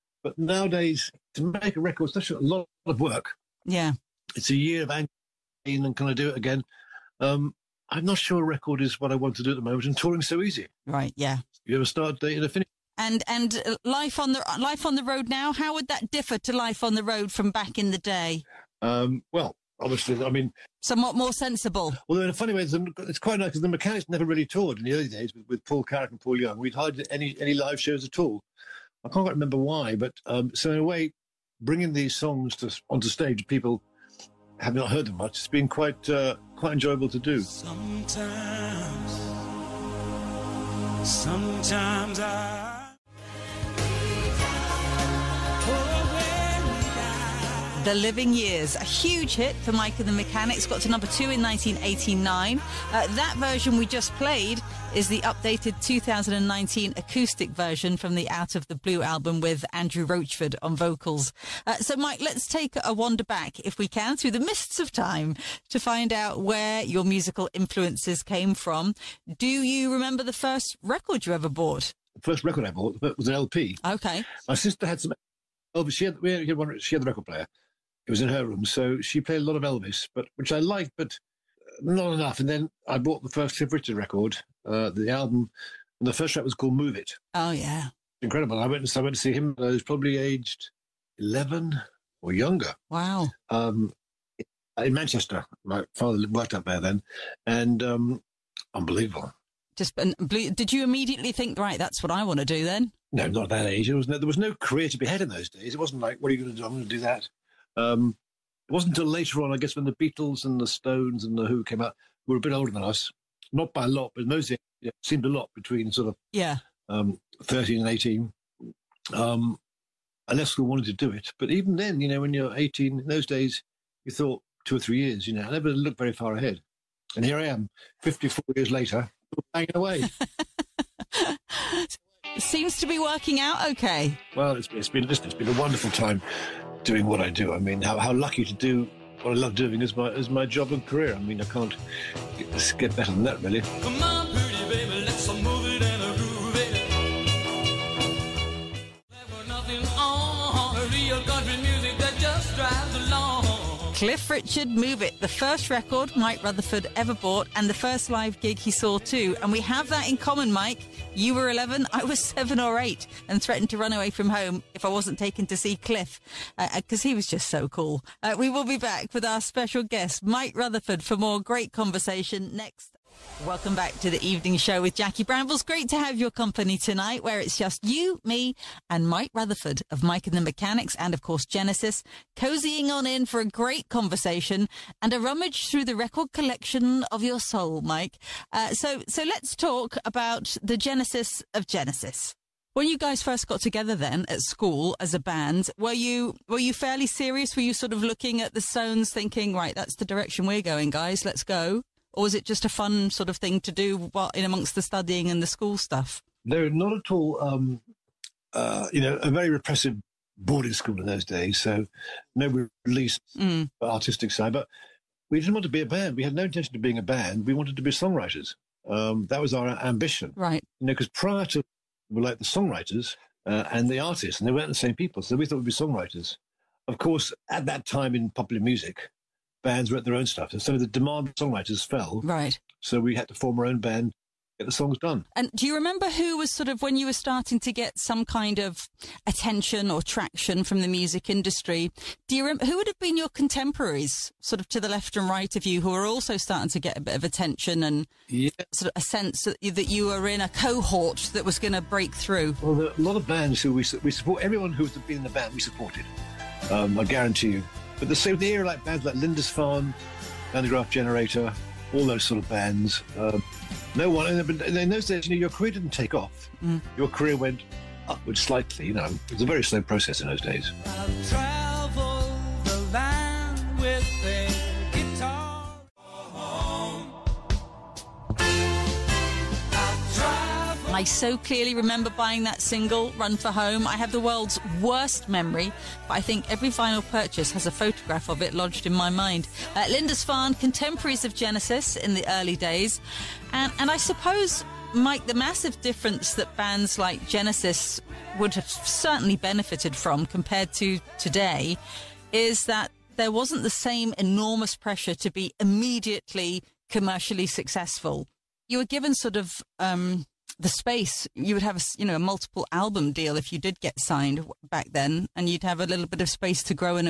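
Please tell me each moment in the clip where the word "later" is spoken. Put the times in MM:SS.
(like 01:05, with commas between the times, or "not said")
01:49, 02:08.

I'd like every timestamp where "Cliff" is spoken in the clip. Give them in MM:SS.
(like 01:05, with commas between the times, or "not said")
01:23, 02:33, 02:45.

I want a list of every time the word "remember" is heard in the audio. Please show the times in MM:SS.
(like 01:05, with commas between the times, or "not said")
00:29, 01:09, 03:55, 04:02, 04:41.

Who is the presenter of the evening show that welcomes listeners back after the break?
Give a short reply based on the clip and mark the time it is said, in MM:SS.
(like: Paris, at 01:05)
Jackie Brambles, at 02:54.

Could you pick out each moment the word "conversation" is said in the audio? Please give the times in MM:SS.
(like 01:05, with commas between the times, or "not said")
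02:51, 03:03.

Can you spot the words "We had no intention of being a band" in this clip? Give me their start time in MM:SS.
03:36.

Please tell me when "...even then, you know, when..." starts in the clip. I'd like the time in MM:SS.
02:01.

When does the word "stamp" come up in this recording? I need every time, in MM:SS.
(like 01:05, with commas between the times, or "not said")
not said.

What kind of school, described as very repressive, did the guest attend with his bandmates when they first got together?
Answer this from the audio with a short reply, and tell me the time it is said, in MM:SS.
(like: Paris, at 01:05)
Boarding school, at 03:30.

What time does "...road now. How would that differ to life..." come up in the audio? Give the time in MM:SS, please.
00:15.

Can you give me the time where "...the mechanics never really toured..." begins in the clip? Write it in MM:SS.
00:23.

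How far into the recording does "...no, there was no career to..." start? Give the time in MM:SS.
01:44.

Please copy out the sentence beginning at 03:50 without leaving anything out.
And so the demand for songwriters fell.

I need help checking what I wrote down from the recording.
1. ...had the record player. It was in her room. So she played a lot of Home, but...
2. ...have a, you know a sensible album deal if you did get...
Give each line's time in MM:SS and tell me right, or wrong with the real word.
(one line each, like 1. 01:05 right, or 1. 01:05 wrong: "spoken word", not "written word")
1. 01:16 wrong: "Elvis", not "Home"
2. 05:11 wrong: "multiple", not "sensible".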